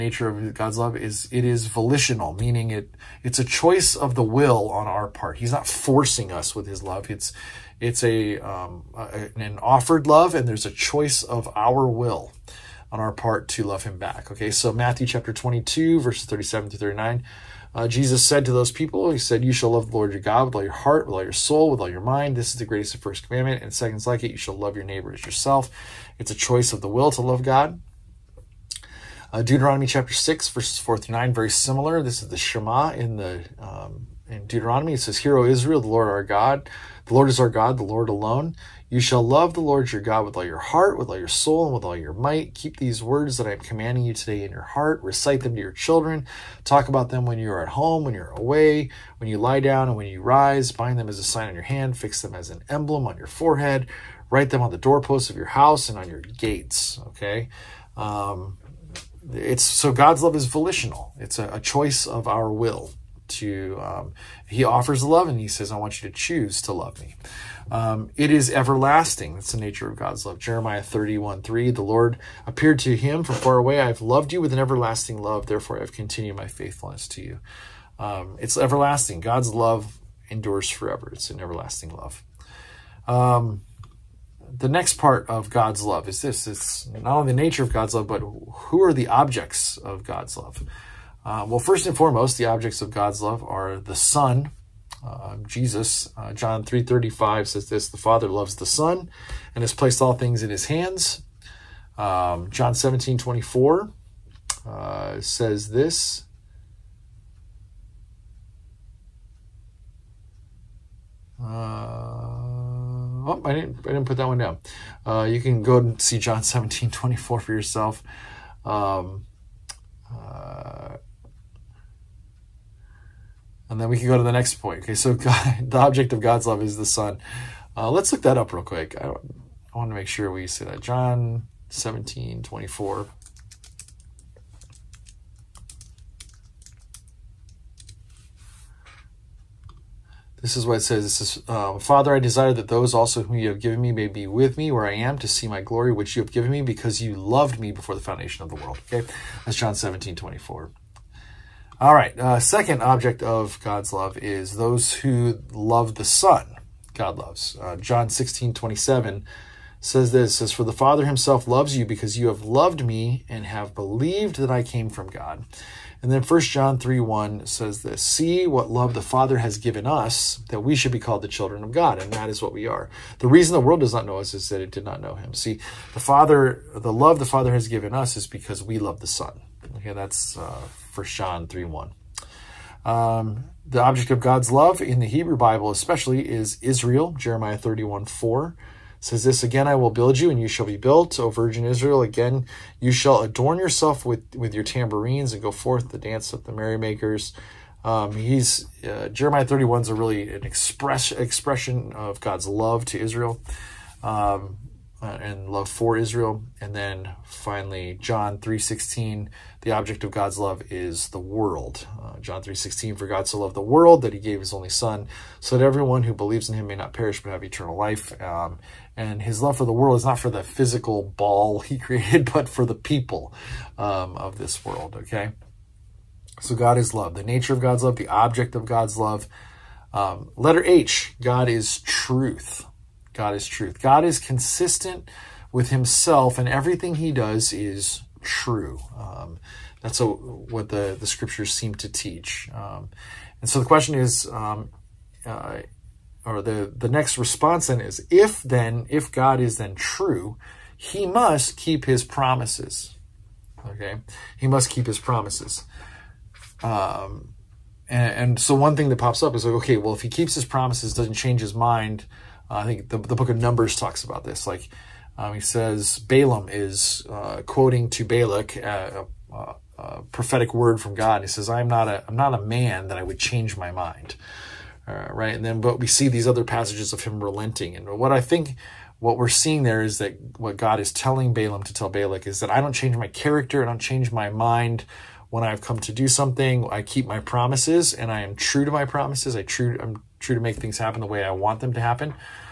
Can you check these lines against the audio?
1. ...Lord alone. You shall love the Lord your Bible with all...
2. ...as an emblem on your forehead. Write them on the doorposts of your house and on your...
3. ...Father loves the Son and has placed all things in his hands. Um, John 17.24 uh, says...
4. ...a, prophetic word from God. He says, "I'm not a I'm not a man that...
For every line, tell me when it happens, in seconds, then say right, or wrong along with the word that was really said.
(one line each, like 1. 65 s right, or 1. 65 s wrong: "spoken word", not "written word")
1. 37 s wrong: "God", not "Bible"
2. 52 s right
3. 97 s right
4. 269 s right.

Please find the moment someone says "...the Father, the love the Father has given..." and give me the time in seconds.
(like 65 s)
175 s.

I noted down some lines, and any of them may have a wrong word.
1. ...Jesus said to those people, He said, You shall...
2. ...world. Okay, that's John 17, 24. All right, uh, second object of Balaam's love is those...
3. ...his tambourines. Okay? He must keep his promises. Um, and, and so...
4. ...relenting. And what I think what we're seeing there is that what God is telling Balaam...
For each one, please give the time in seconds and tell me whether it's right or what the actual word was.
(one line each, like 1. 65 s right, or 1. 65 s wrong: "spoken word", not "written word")
1. 17 s right
2. 148 s wrong: "God", not "Balaam"
3. 251 s wrong: "promises", not "tambourines"
4. 277 s right.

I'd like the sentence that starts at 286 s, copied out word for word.
I keep my promises and I am true to my promises.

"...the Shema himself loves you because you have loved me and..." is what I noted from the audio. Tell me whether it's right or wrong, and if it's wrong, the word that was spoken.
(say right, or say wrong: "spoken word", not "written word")
wrong: "Father", not "Shema".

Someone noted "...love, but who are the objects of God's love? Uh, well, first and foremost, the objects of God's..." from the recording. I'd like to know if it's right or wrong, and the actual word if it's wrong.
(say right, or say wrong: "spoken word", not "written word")
right.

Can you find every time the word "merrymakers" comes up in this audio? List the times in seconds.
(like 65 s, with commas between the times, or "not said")
196 s.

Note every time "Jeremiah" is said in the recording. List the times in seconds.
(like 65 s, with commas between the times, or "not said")
70 s, 187 s, 199 s.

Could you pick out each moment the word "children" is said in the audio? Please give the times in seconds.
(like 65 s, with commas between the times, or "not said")
45 s, 171 s.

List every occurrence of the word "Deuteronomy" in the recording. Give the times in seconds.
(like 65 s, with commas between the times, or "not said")
29 s, 34 s.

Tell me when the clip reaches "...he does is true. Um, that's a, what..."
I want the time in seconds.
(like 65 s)
236 s.